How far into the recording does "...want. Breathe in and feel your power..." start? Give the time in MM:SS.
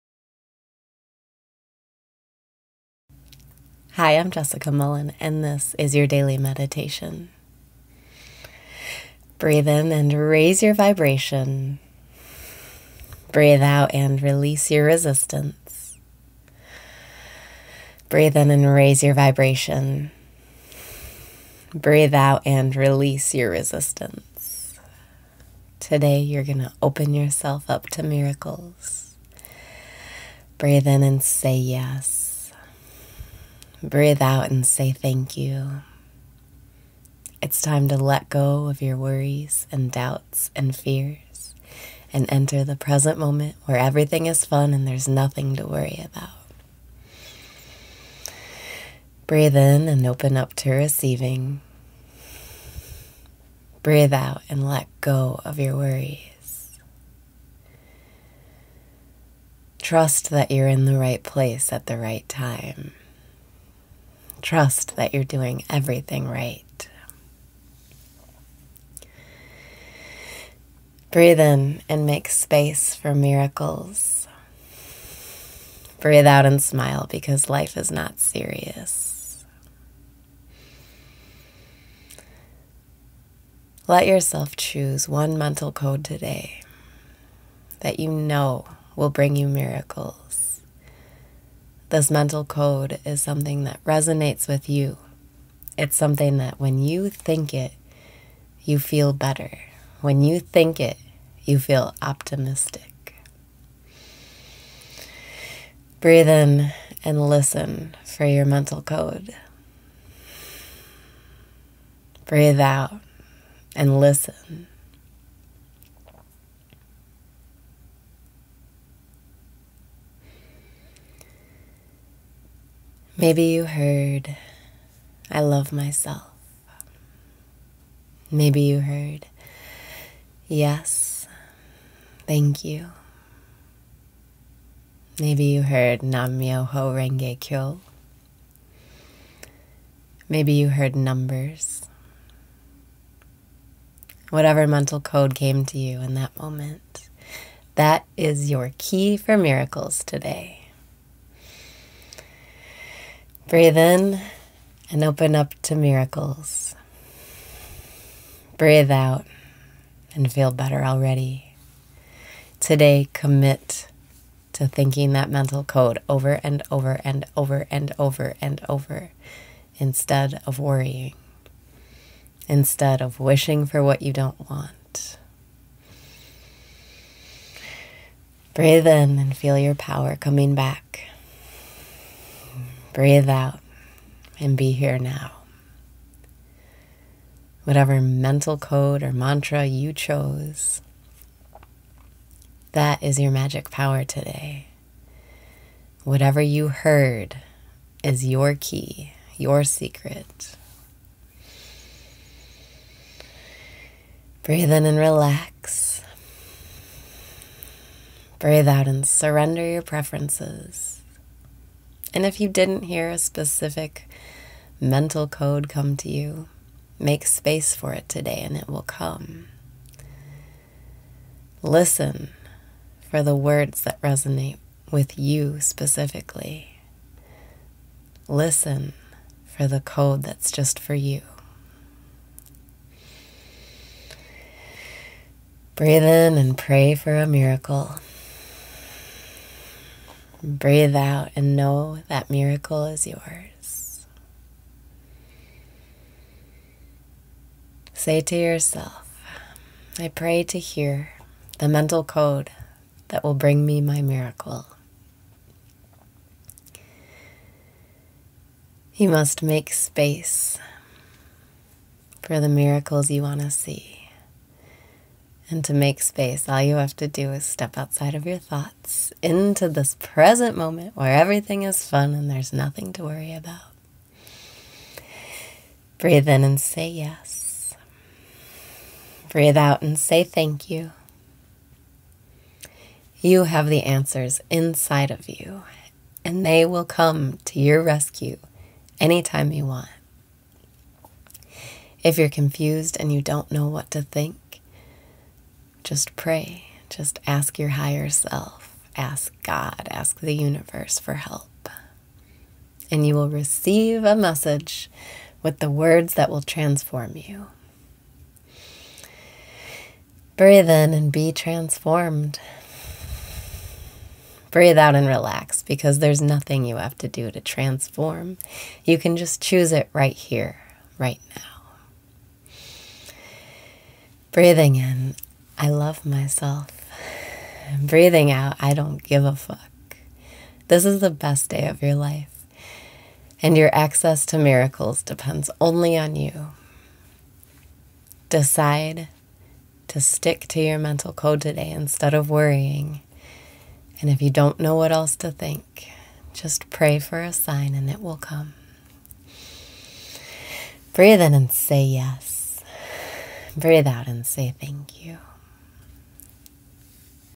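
02:54.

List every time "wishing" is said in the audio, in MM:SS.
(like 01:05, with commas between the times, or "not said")
02:53.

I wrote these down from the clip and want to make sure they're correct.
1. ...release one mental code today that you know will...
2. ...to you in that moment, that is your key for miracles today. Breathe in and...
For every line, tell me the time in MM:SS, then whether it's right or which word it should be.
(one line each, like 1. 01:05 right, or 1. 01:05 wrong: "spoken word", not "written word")
1. 01:24 wrong: "choose", not "release"
2. 02:25 right.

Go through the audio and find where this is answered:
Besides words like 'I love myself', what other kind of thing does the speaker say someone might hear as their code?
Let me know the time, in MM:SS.
02:20.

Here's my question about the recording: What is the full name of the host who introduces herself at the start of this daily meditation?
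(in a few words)
Jessica Mullen.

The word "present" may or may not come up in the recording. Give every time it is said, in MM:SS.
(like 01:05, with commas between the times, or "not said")
00:42, 04:29.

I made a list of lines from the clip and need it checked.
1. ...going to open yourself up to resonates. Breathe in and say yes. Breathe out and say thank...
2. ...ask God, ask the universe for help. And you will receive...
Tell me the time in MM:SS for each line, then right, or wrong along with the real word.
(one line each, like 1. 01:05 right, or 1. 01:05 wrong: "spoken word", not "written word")
1. 00:26 wrong: "miracles", not "resonates"
2. 04:58 right.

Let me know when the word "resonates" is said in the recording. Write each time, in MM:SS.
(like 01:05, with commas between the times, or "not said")
01:33, 03:44.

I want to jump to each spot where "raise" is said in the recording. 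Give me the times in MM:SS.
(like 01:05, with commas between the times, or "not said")
00:10, 00:18.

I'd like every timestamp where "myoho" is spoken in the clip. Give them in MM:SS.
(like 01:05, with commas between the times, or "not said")
02:16.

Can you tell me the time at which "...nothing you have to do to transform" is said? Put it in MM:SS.
05:16.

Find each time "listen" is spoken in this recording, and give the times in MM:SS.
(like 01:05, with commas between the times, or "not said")
01:47, 01:53, 03:41, 03:48.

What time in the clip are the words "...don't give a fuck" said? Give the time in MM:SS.
05:28.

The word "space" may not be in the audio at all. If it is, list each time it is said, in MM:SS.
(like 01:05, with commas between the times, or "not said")
01:12, 03:37, 04:19, 04:26.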